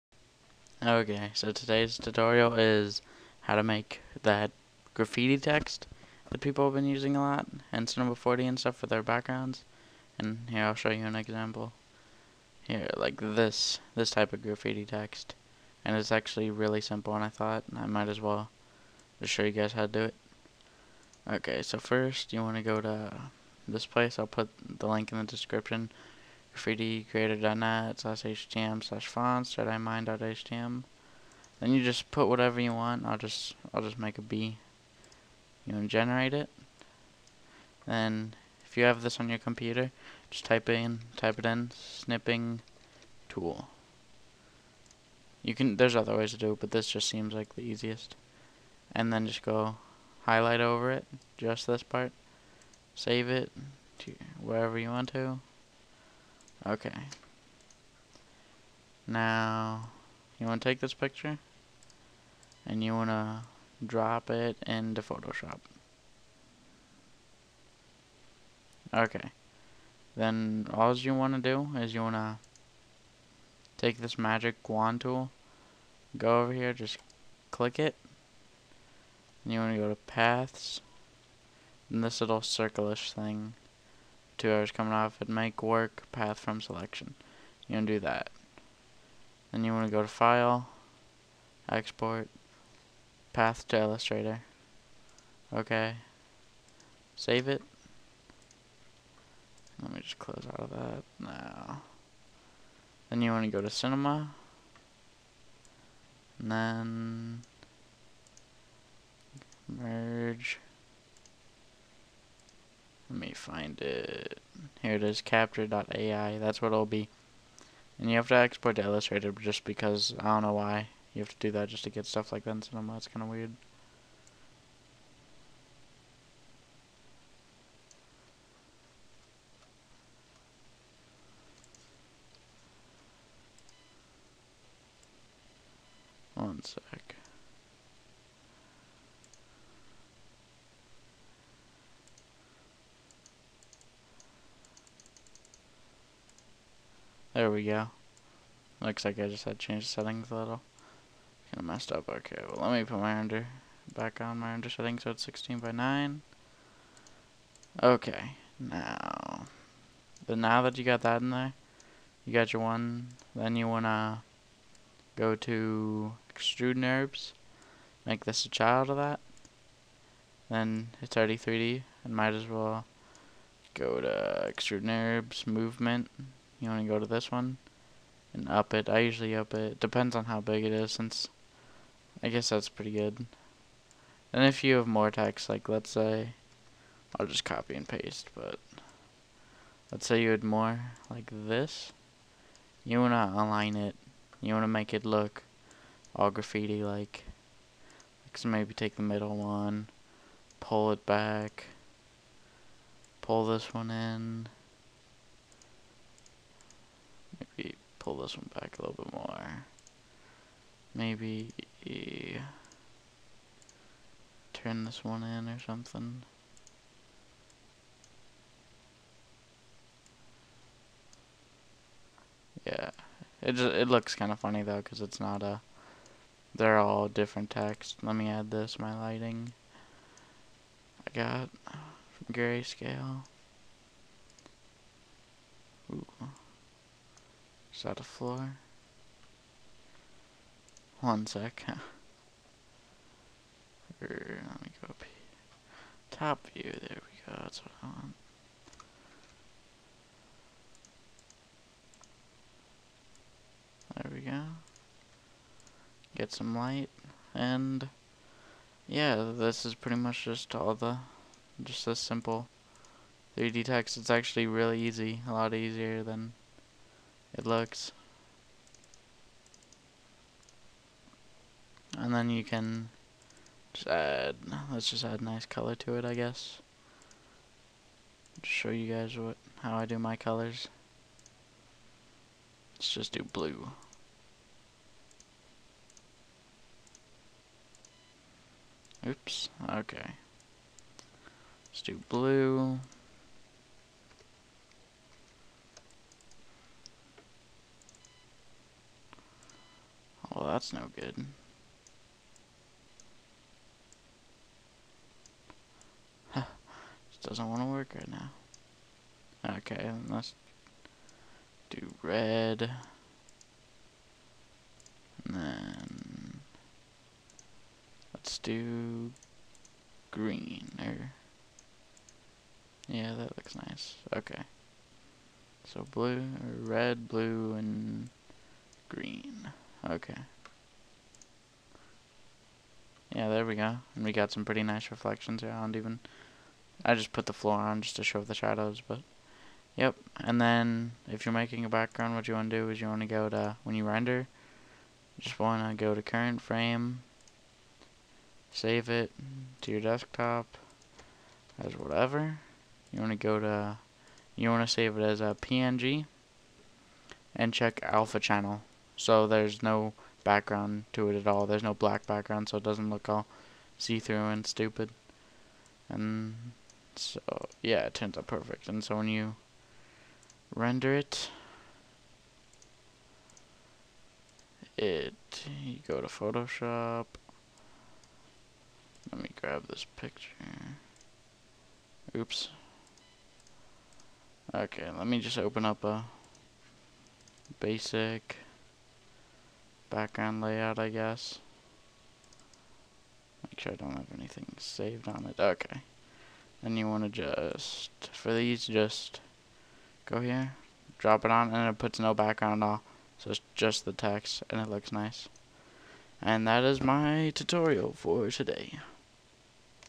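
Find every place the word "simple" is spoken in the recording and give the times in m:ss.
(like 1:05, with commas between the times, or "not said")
0:16, 4:21.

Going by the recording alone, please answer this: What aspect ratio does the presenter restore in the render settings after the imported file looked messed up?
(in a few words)
16 by 9.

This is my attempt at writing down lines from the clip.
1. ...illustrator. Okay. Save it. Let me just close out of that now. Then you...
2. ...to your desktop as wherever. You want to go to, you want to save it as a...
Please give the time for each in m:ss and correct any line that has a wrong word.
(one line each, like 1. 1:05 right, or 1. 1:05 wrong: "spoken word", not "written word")
1. 1:33 right
2. 5:49 wrong: "whatever", not "wherever".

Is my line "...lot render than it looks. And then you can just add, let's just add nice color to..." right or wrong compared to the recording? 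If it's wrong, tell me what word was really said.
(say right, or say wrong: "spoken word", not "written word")
wrong: "easier", not "render".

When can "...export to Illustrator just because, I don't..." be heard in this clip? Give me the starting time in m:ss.
1:58.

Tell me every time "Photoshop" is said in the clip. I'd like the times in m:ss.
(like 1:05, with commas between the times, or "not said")
1:05, 6:16.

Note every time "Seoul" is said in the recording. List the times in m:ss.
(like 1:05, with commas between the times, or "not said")
not said.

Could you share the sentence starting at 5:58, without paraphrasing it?
So there's no background to it at all.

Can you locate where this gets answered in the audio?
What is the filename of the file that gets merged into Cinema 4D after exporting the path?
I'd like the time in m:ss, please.
1:55.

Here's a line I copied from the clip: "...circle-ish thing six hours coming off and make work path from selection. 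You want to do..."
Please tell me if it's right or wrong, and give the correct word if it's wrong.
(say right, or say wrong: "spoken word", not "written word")
wrong: "two", not "six".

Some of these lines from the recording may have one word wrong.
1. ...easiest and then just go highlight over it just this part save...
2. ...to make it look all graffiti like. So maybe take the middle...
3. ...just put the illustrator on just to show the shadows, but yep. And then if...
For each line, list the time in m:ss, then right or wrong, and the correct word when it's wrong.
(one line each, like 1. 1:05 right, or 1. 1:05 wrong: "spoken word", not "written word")
1. 0:47 right
2. 3:14 right
3. 5:36 wrong: "floor", not "illustrator".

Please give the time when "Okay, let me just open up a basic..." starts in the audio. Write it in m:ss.
6:24.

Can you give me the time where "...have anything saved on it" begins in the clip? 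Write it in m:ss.
6:33.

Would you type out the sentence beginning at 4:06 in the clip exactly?
Top view, there we go, that's what I want.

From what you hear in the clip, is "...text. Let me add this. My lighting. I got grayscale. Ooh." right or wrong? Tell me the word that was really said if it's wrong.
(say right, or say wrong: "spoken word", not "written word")
right.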